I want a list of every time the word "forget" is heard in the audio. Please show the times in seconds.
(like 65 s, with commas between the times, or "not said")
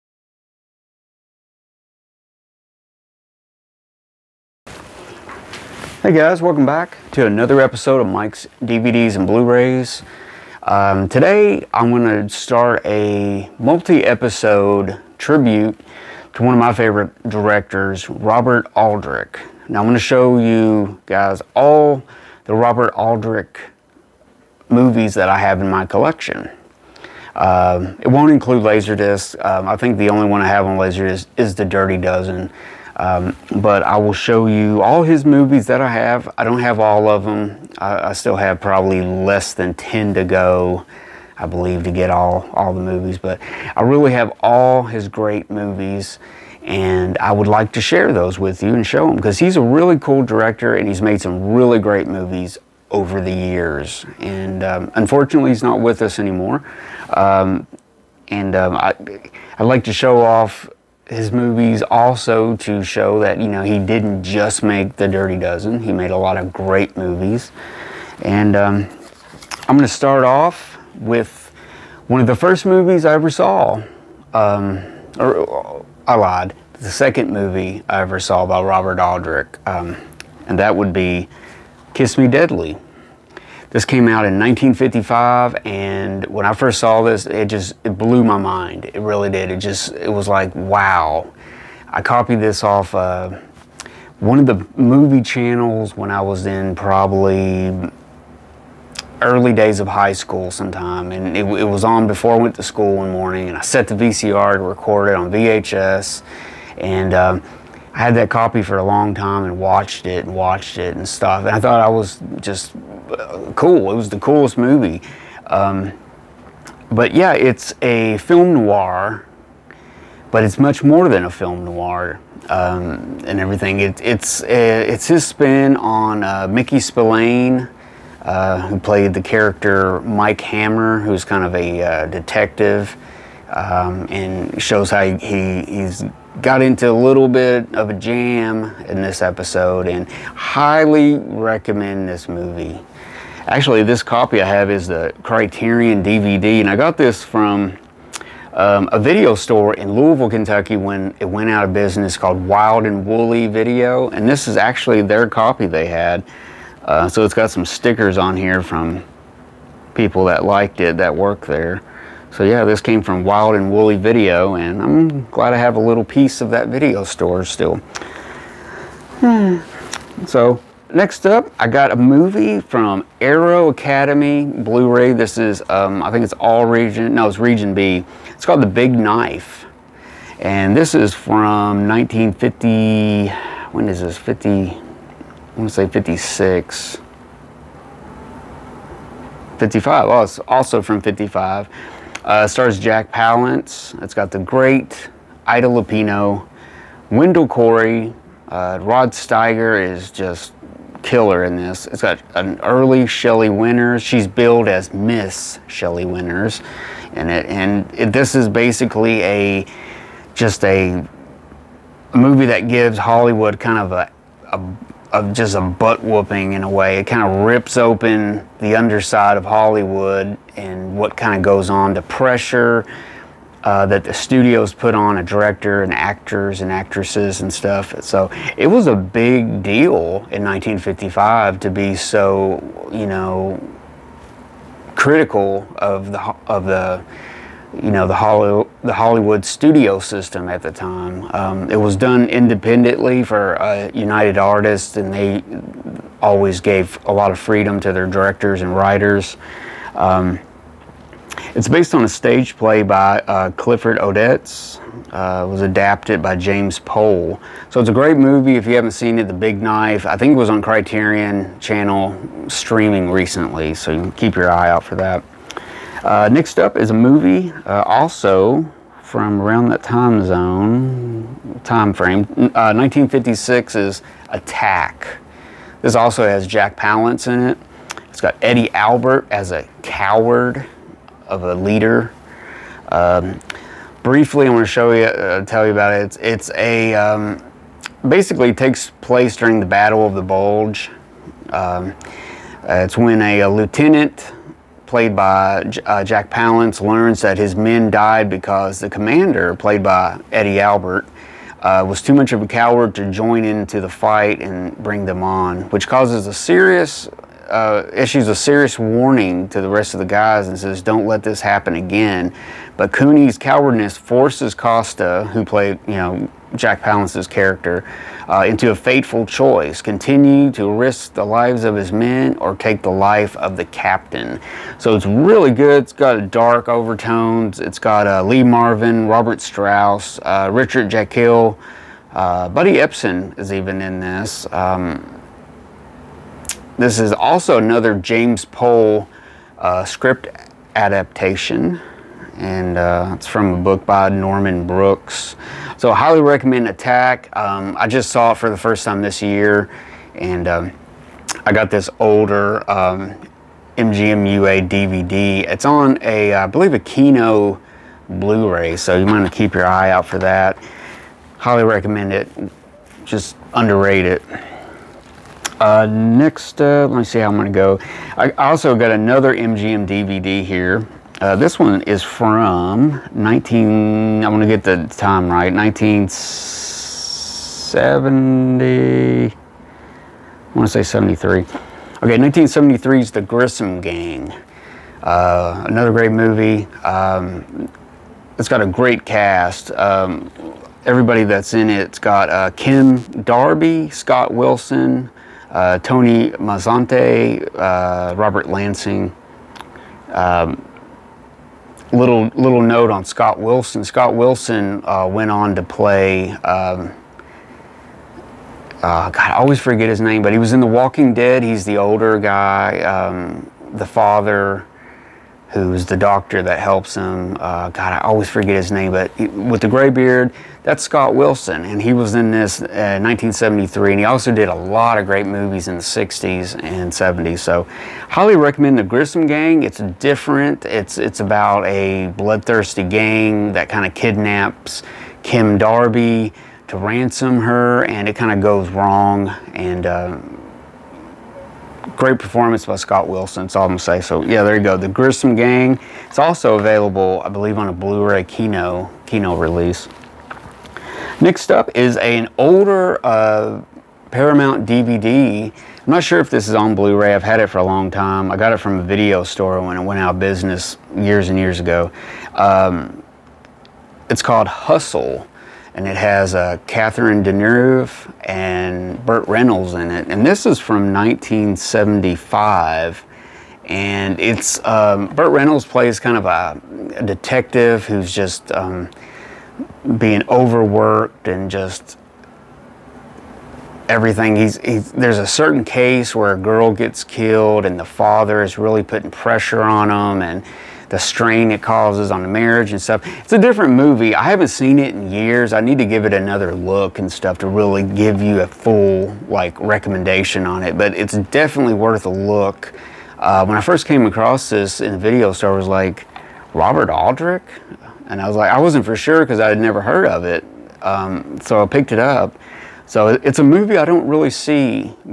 409 s, 418 s.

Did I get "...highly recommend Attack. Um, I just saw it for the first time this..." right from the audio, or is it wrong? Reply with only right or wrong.
right.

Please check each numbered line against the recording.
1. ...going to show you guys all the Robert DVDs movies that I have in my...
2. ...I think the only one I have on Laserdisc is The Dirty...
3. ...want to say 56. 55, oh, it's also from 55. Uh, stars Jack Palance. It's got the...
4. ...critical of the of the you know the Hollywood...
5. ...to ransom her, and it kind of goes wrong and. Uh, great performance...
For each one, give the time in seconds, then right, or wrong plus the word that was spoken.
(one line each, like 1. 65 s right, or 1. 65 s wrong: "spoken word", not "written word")
1. 19 s wrong: "Aldrich", not "DVDs"
2. 29 s right
3. 185 s right
4. 234 s right
5. 436 s right.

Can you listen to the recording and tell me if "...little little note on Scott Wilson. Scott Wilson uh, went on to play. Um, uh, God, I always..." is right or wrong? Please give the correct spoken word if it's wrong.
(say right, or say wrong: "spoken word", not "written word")
right.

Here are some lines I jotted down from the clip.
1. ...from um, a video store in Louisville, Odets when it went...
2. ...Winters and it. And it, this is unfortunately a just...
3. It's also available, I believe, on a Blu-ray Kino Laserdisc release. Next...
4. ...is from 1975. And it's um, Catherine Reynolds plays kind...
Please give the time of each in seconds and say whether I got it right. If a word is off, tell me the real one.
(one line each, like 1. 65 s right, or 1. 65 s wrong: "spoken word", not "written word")
1. 147 s wrong: "Kentucky", not "Odets"
2. 206 s wrong: "basically", not "unfortunately"
3. 446 s wrong: "Kino", not "Laserdisc"
4. 470 s wrong: "Burt", not "Catherine".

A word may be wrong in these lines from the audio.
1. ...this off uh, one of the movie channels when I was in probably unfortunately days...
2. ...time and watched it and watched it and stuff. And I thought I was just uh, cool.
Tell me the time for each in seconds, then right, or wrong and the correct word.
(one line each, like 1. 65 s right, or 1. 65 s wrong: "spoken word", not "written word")
1. 92 s wrong: "early", not "unfortunately"
2. 109 s right.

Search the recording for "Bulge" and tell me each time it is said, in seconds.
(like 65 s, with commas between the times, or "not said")
290 s.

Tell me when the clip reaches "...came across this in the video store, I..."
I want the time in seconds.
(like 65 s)
503 s.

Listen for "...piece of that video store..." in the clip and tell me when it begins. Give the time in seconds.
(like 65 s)
166 s.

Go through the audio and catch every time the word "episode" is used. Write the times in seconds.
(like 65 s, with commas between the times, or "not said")
7 s, 13 s, 139 s.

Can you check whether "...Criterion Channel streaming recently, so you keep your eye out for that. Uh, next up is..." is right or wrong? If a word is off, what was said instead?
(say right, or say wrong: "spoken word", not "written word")
right.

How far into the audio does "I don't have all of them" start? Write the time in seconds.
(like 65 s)
36 s.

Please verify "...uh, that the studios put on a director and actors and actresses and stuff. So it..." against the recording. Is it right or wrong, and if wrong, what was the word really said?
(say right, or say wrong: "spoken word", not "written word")
right.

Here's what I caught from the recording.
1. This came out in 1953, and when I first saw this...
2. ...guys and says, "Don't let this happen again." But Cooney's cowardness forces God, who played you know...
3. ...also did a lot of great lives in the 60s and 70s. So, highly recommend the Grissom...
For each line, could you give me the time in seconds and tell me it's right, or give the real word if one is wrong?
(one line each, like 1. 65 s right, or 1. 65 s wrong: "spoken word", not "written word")
1. 83 s wrong: "1955", not "1953"
2. 310 s wrong: "Costa", not "God"
3. 424 s wrong: "movies", not "lives".